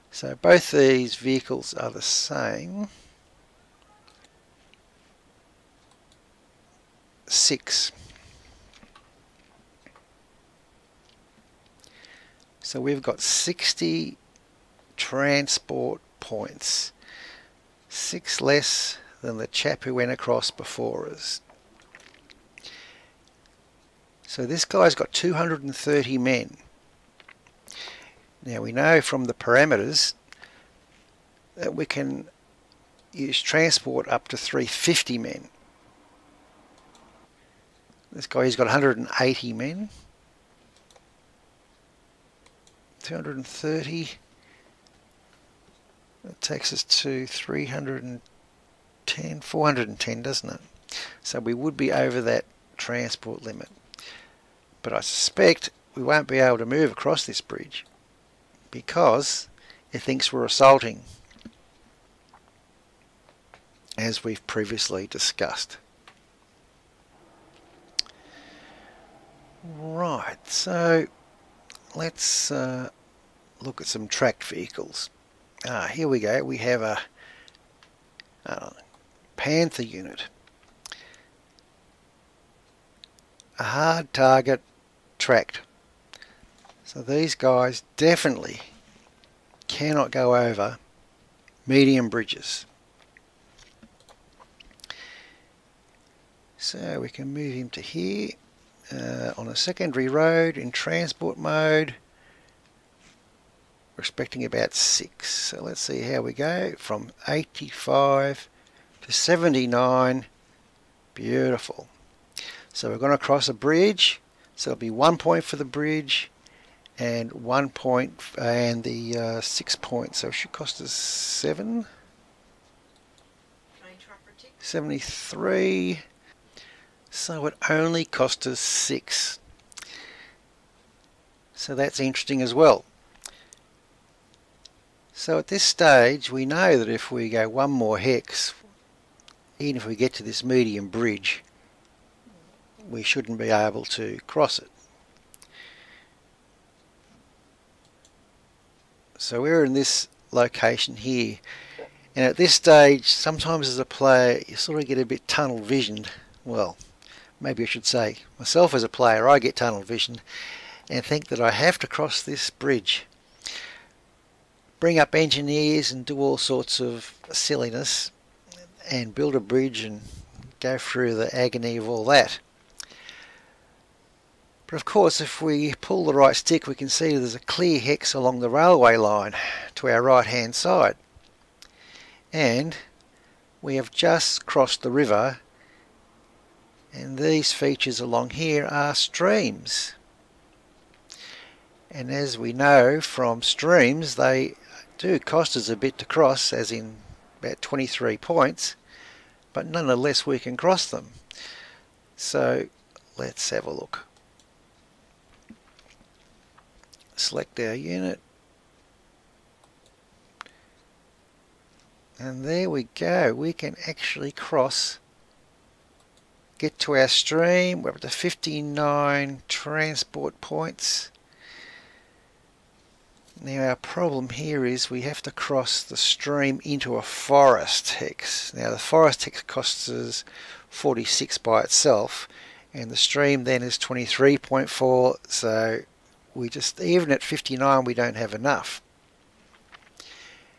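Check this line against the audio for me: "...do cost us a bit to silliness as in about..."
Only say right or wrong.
wrong.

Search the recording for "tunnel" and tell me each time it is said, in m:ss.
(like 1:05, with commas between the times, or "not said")
2:35, 2:39.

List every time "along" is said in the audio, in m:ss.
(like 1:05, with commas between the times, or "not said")
2:58, 3:07.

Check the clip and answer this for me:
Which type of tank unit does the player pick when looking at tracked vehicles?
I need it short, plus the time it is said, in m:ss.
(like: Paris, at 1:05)
Panther, at 1:19.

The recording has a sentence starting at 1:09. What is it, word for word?
Right, so let's uh, look at some tracked vehicles.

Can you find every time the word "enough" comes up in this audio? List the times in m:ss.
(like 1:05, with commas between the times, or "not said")
3:58.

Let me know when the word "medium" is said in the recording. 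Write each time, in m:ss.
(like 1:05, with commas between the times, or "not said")
1:31, 2:20.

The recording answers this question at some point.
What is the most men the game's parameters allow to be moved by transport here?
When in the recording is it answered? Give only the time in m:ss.
0:34.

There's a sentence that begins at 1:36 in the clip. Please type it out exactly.
So we can move him to here uh, on a secondary road in transport mode.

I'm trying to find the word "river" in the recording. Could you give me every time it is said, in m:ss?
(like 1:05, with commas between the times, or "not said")
3:04.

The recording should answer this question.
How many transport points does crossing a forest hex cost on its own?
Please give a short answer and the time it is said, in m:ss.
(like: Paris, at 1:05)
46, at 3:50.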